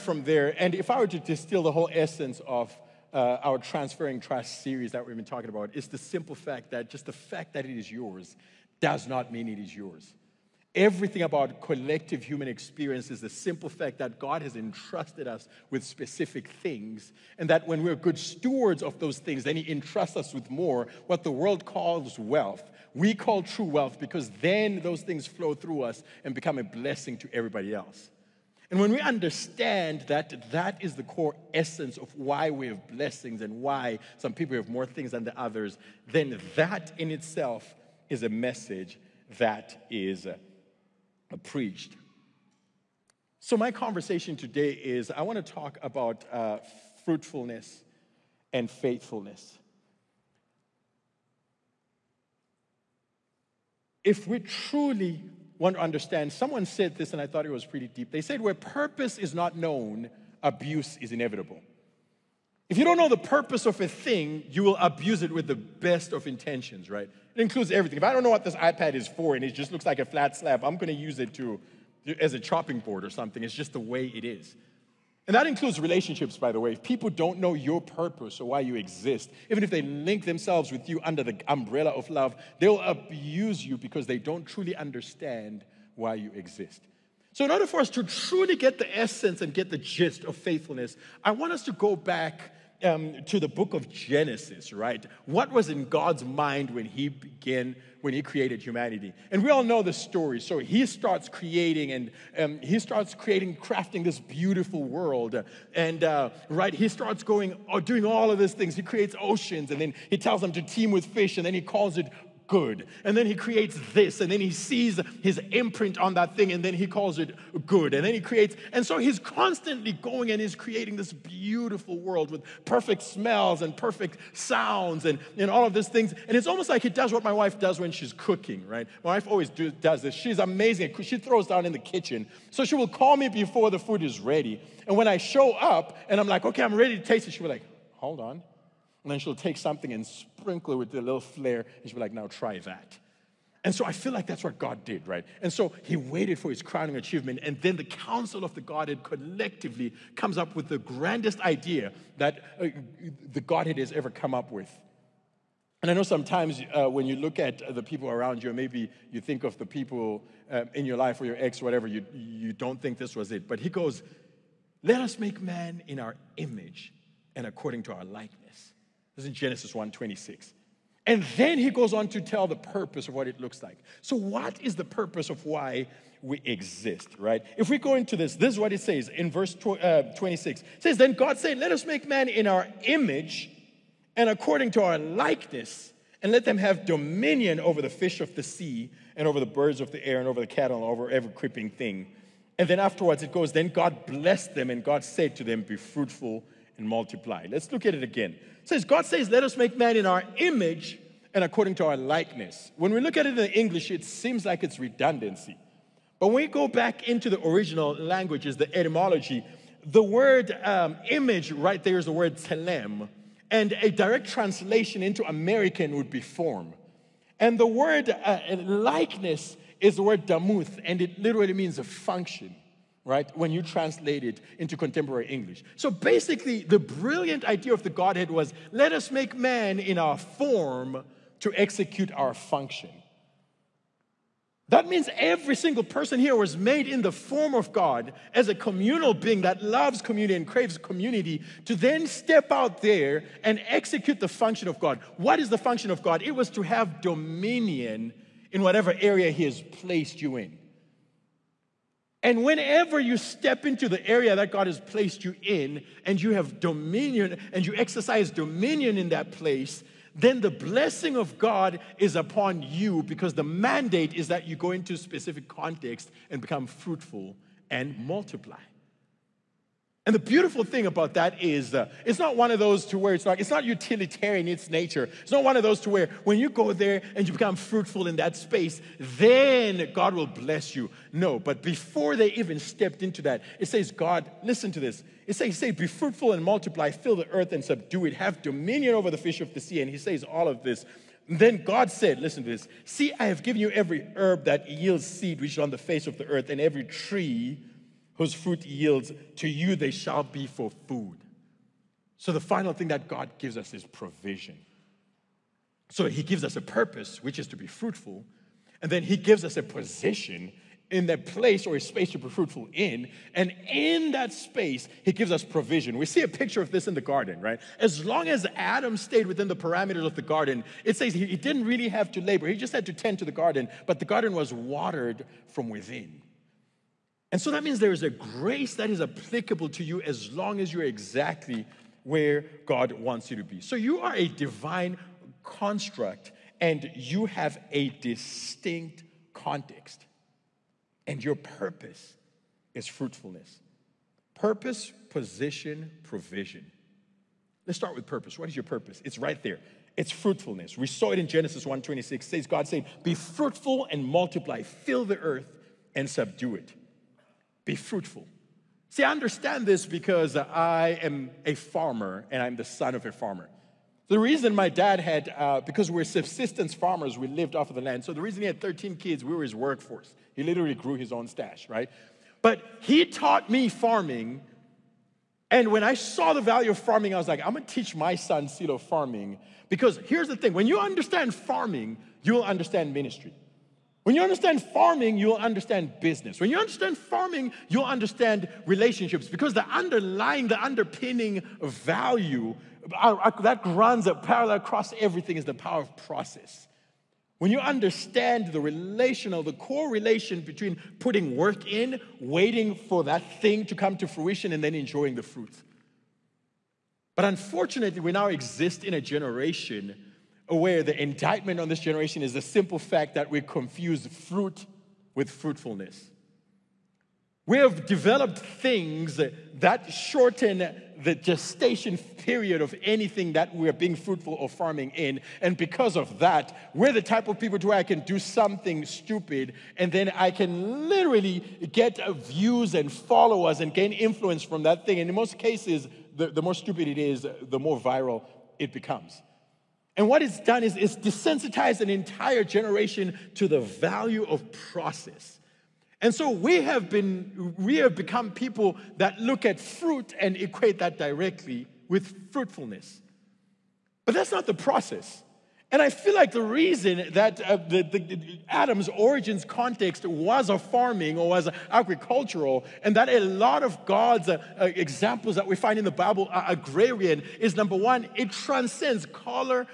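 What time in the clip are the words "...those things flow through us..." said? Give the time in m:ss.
0:24.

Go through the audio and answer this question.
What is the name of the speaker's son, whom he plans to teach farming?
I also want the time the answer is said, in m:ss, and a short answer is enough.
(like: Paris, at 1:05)
Silo, at 6:18.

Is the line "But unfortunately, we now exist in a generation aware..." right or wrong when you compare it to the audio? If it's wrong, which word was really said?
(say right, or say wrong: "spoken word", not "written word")
right.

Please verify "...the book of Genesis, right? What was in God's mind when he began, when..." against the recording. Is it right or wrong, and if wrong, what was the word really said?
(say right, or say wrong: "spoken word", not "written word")
right.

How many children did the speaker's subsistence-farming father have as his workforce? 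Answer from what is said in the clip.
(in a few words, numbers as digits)
13.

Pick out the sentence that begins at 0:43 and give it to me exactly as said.
So, my conversation today is I want to talk about uh, fruitfulness and faithfulness.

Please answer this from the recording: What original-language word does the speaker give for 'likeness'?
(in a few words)
damuth.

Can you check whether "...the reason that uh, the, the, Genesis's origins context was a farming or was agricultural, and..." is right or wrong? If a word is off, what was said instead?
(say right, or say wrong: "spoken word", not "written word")
wrong: "Adam", not "Genesis".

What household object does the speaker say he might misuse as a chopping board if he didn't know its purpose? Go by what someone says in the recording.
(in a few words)
iPad.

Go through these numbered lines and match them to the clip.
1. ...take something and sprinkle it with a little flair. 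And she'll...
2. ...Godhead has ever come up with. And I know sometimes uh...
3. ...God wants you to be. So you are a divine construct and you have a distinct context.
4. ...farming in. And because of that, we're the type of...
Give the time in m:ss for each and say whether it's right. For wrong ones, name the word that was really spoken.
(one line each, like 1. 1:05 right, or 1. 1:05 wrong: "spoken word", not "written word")
1. 2:19 right
2. 2:33 right
3. 5:32 right
4. 7:04 right.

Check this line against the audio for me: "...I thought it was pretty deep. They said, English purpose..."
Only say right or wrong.
wrong.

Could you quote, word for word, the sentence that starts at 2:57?
If we go into this, this is what it says in verse uh, 26.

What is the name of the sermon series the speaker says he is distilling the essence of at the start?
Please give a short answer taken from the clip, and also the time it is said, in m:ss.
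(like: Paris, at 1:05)
Transferring Trust, at 0:03.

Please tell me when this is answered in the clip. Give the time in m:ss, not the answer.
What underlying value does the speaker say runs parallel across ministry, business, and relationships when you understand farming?
6:35.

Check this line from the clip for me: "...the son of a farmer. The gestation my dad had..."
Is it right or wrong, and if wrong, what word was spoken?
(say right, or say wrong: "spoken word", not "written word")
wrong: "reason", not "gestation".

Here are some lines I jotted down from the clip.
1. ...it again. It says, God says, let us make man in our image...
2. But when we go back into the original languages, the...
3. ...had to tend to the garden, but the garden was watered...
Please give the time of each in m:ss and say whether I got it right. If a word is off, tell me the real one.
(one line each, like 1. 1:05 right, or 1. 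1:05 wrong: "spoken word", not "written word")
1. 3:17 right
2. 3:26 right
3. 5:22 right.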